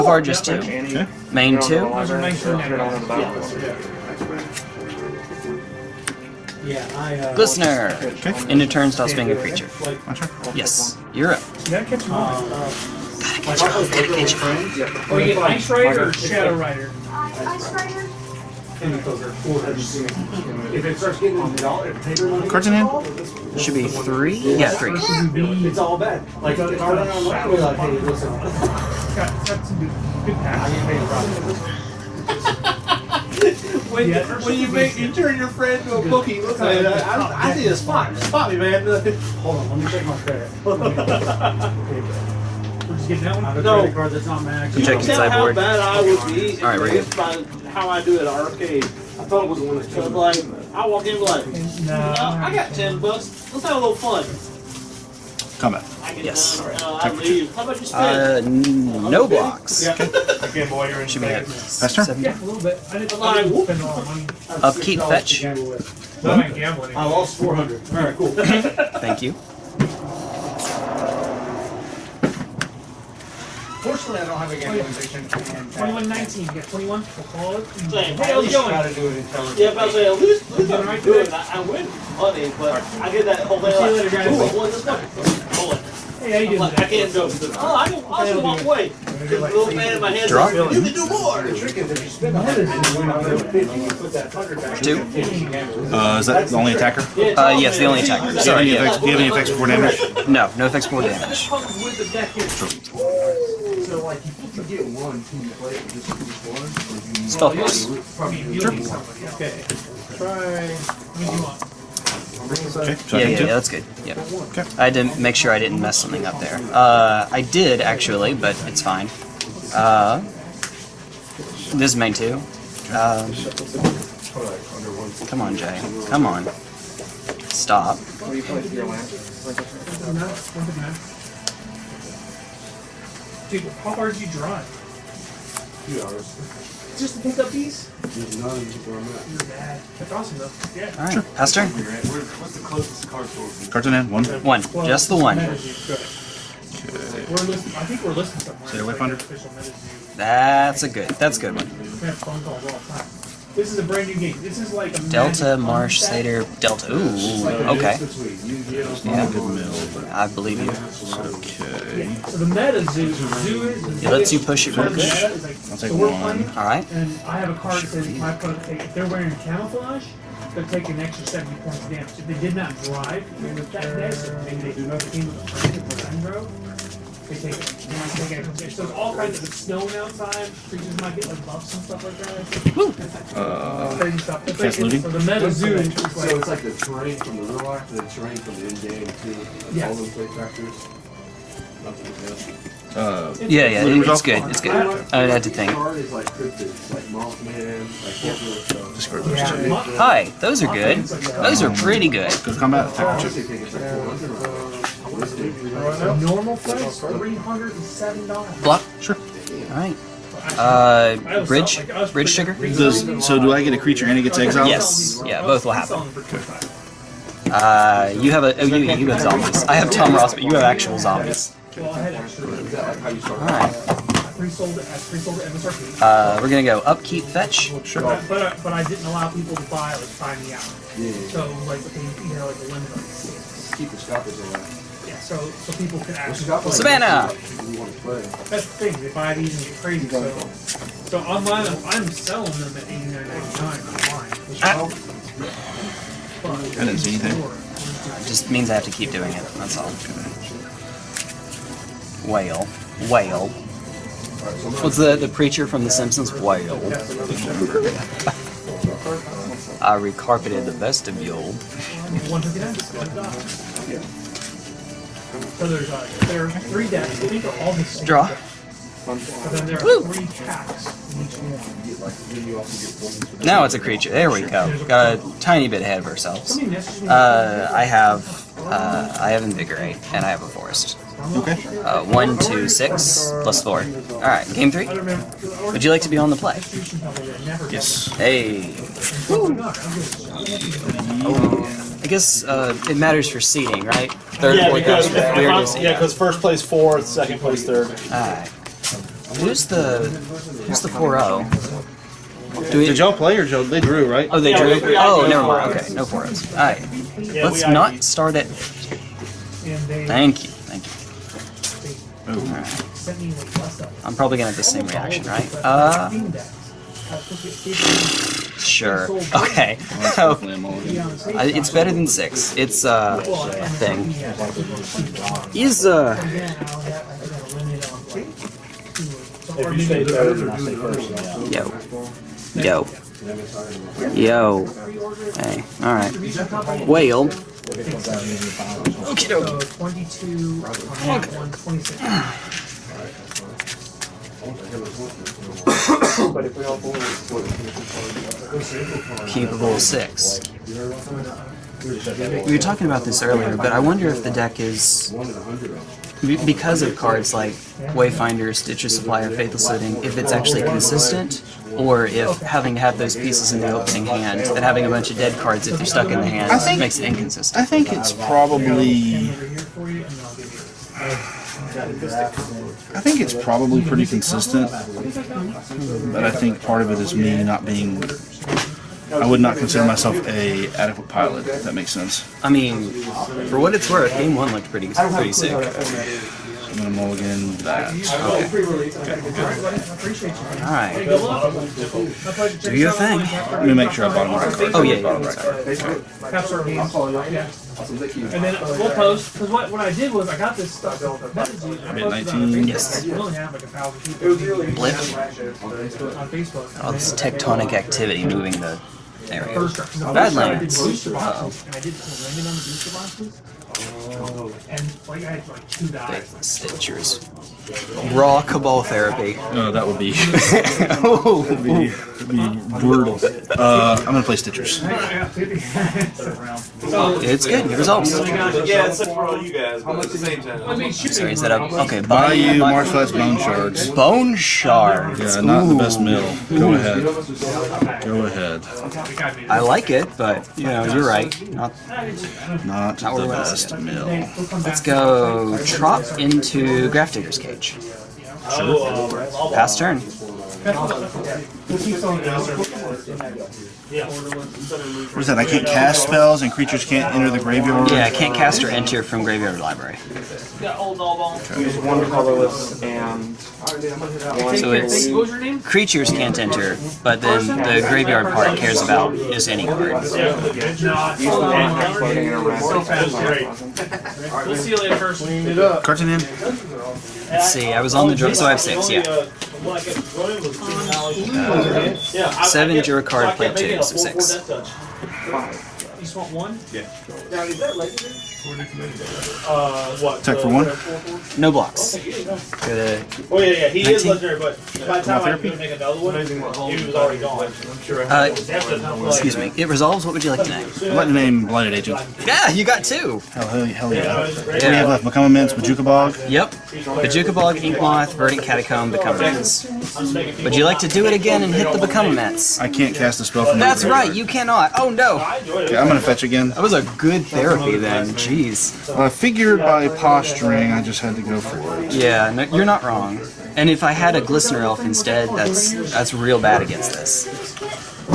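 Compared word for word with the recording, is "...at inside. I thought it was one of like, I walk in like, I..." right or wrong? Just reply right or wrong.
wrong.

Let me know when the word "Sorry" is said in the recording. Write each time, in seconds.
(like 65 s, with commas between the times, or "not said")
98 s, 431 s.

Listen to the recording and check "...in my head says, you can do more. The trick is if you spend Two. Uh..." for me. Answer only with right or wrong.
right.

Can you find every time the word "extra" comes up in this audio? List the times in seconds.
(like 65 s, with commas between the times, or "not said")
171 s.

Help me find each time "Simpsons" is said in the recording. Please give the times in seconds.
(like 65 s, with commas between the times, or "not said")
255 s.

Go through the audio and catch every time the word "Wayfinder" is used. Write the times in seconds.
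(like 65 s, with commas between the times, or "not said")
357 s.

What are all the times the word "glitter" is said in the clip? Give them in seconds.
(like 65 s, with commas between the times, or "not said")
not said.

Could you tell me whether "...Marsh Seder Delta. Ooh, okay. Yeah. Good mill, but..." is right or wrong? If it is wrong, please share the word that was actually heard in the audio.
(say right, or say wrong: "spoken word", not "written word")
right.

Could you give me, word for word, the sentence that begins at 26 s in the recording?
Like, if I run like, hey, listen.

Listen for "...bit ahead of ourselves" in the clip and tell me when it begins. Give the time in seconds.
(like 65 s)
275 s.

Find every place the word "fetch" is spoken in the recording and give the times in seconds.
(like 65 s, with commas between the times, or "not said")
65 s, 227 s, 516 s.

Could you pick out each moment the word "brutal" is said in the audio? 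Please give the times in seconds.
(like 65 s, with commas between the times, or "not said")
422 s.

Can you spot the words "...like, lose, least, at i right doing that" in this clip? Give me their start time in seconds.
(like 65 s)
79 s.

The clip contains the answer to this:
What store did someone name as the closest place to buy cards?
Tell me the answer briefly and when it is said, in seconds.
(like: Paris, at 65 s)
Carton, at 143 s.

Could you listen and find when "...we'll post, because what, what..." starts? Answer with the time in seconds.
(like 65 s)
398 s.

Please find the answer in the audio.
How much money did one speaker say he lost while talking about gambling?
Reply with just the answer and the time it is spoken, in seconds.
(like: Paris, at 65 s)
400, at 67 s.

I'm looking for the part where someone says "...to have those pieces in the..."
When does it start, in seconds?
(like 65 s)
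362 s.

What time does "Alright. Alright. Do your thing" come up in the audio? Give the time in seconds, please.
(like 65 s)
390 s.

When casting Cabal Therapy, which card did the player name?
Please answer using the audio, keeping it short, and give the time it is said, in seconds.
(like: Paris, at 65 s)
Blighted Agent, at 501 s.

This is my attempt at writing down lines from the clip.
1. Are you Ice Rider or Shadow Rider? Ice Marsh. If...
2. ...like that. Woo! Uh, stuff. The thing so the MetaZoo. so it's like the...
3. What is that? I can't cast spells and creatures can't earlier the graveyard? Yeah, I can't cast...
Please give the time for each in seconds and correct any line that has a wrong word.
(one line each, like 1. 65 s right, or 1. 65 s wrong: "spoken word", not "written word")
1. 15 s wrong: "Rider", not "Marsh"
2. 182 s right
3. 455 s wrong: "enter", not "earlier".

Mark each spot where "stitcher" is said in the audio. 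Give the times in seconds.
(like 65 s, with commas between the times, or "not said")
358 s, 416 s, 424 s.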